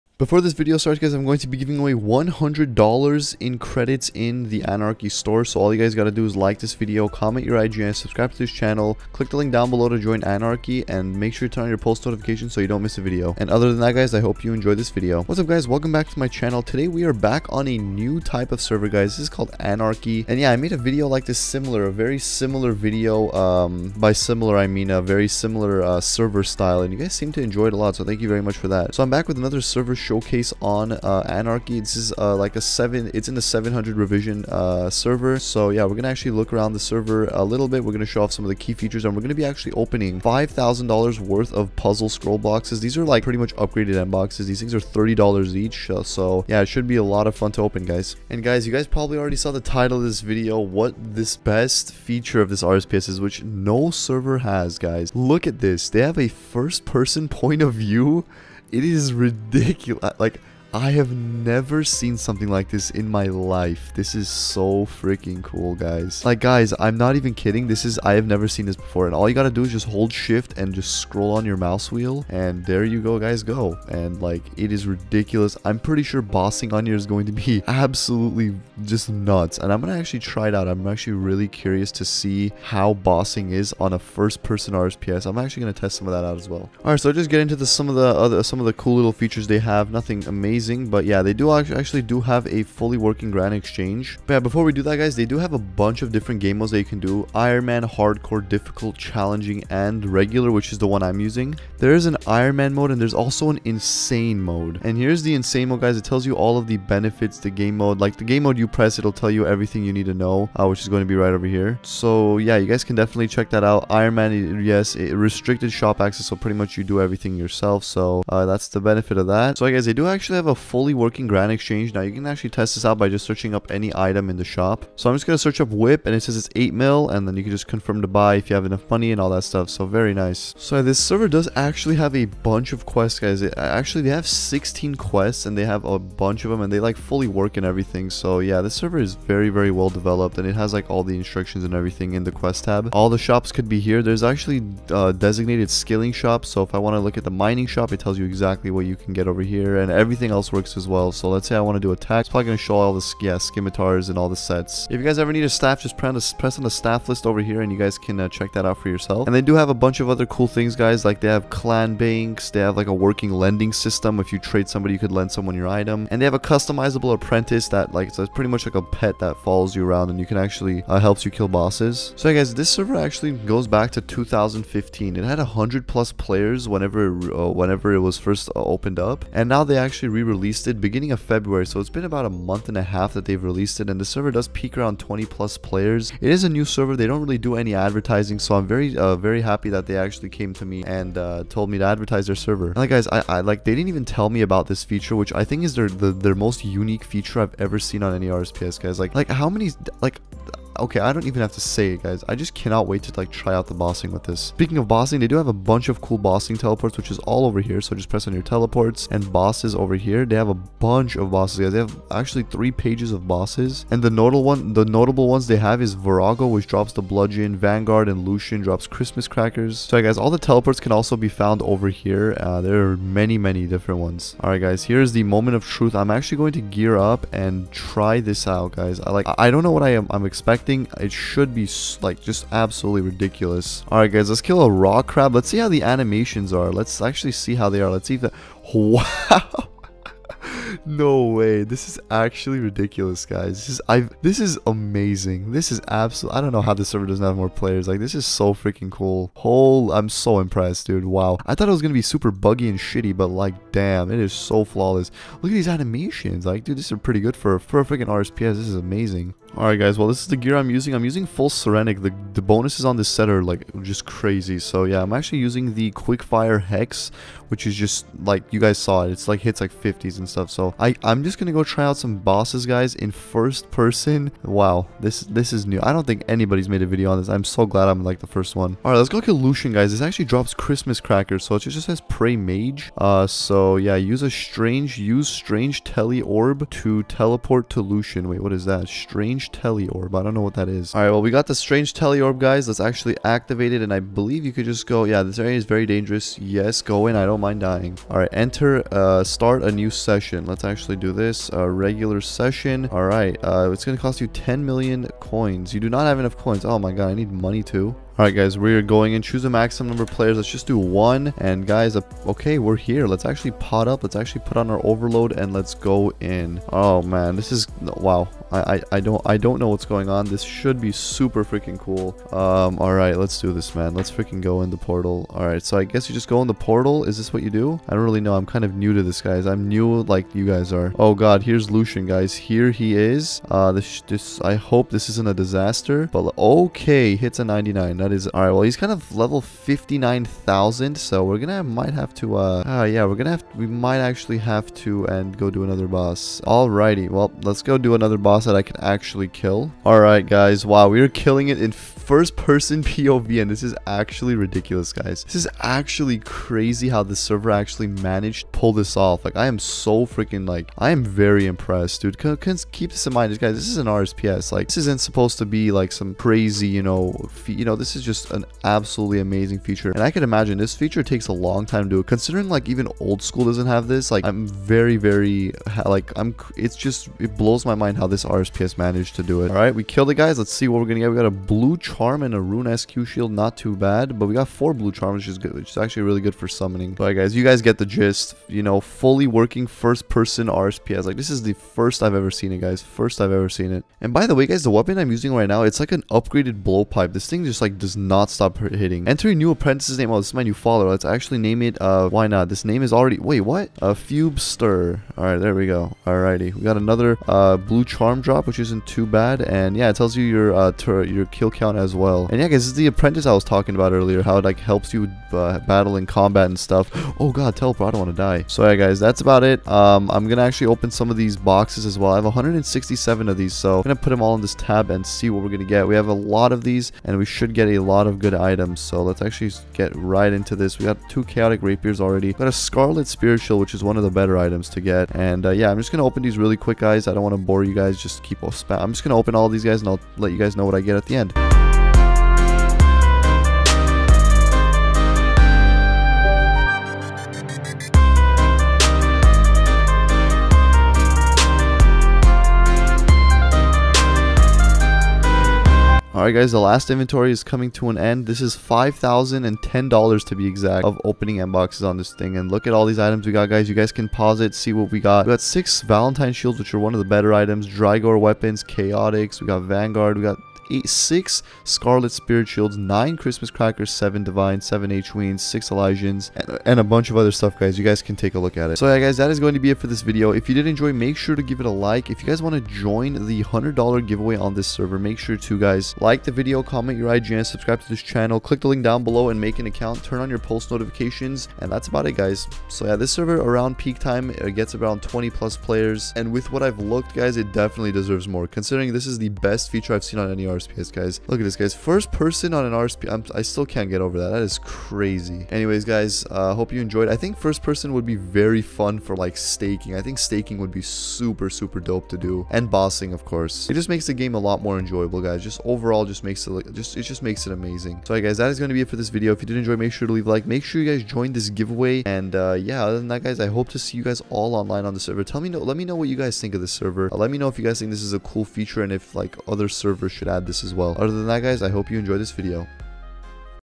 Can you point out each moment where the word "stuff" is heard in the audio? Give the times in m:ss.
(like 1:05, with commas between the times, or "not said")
2:09, 4:30, 6:56, 7:57.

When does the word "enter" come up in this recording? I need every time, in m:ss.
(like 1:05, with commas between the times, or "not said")
4:58, 6:39.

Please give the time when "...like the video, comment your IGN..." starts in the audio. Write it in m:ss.
8:06.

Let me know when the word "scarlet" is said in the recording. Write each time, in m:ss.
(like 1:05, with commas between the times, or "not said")
7:12, 7:51.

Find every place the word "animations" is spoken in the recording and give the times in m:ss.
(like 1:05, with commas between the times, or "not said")
3:55, 4:15.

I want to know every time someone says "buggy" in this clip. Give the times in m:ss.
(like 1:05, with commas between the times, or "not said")
4:12.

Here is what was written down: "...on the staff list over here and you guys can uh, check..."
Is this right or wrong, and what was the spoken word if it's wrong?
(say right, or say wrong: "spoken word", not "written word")
right.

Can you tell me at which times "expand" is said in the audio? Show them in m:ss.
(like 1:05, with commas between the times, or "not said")
not said.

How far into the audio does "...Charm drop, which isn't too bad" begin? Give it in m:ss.
6:47.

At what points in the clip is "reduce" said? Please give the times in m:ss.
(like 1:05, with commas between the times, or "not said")
not said.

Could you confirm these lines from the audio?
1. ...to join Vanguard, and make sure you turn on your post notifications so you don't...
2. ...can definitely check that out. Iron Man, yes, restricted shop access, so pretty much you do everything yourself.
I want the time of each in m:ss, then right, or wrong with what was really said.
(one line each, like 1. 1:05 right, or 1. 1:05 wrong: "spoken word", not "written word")
1. 0:09 wrong: "Anarchy", not "Vanguard"
2. 1:52 right.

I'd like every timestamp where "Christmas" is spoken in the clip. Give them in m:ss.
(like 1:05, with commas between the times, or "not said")
3:38, 4:40, 7:53.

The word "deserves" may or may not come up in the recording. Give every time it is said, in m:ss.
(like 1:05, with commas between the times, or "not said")
8:17.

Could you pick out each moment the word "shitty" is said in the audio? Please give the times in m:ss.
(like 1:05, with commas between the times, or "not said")
4:12.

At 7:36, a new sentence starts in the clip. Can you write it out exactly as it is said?
Alright guys, the last inventory is coming to an end.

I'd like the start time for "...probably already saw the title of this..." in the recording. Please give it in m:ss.
0:48.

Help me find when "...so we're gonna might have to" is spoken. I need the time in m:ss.
5:40.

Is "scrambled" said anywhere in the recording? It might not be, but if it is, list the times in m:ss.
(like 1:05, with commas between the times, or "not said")
not said.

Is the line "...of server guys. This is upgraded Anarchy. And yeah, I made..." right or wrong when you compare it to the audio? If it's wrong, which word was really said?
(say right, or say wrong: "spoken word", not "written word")
wrong: "called", not "upgraded".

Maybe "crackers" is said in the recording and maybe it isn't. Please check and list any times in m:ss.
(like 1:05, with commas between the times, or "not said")
3:39, 4:40, 7:53.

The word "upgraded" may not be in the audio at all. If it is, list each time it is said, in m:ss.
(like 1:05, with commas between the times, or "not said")
0:43, 6:36.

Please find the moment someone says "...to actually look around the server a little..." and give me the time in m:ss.
0:36.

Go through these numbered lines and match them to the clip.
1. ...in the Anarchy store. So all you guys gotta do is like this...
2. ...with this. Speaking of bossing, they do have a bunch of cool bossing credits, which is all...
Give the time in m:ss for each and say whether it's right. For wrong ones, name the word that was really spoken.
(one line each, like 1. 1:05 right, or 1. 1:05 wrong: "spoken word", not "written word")
1. 0:04 right
2. 3:24 wrong: "teleports", not "credits".